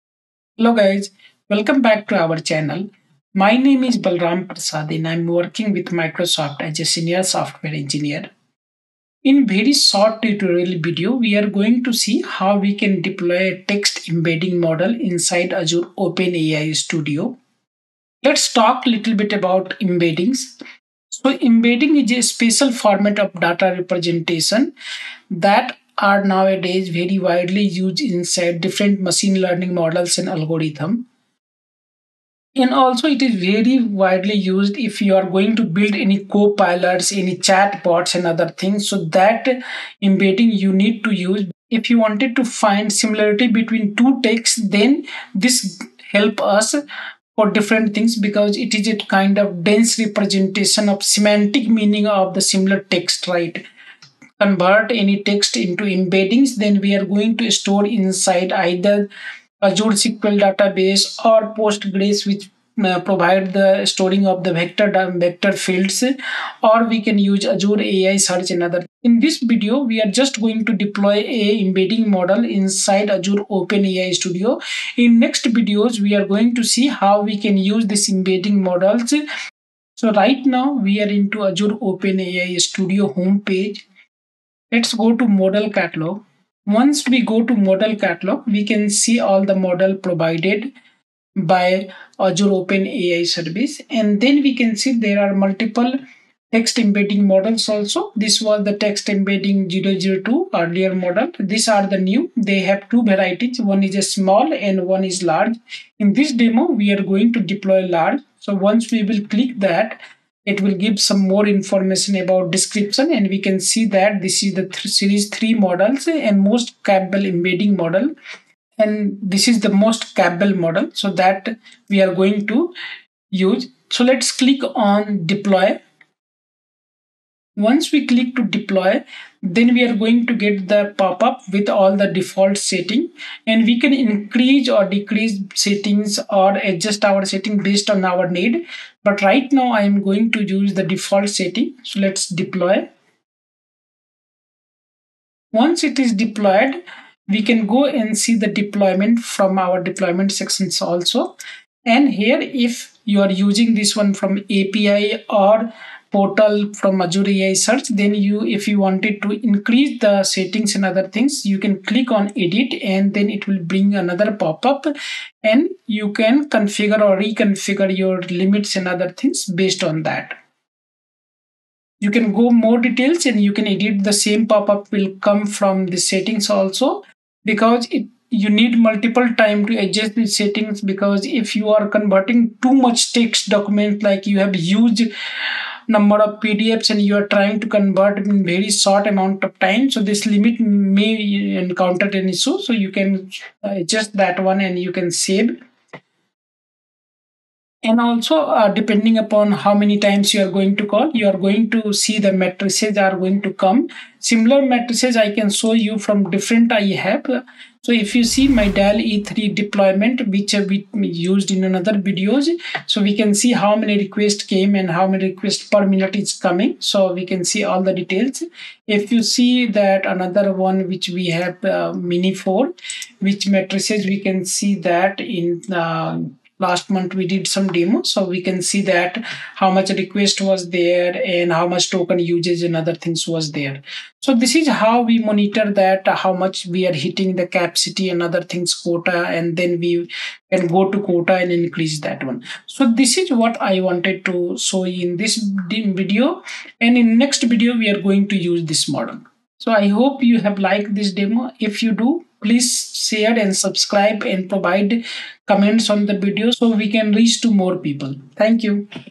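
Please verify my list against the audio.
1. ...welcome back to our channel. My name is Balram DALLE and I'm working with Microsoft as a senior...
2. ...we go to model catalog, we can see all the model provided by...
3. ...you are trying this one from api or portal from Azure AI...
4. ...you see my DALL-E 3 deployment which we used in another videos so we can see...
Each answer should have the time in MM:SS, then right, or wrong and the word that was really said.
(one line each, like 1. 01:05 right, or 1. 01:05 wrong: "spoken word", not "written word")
1. 00:01 wrong: "Prasad", not "DALLE"
2. 01:27 right
3. 02:33 wrong: "using", not "trying"
4. 03:28 right.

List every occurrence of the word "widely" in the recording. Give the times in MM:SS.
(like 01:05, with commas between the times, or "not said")
00:27, 00:33.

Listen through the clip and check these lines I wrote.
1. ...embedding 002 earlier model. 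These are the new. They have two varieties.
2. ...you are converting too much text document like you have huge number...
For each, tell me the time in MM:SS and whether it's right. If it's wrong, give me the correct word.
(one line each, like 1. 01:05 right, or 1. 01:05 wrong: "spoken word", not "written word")
1. 01:39 right
2. 03:01 right.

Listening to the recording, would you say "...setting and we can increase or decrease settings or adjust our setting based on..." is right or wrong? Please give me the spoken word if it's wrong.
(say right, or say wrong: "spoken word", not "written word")
right.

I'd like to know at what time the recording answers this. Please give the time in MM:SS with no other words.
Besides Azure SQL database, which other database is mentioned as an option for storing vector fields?
01:01.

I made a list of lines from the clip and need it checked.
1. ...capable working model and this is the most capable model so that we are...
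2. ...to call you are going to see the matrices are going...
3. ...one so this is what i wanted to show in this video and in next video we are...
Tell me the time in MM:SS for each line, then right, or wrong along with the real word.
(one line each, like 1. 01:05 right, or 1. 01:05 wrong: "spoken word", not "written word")
1. 01:56 wrong: "embedding", not "working"
2. 03:20 right
3. 04:02 right.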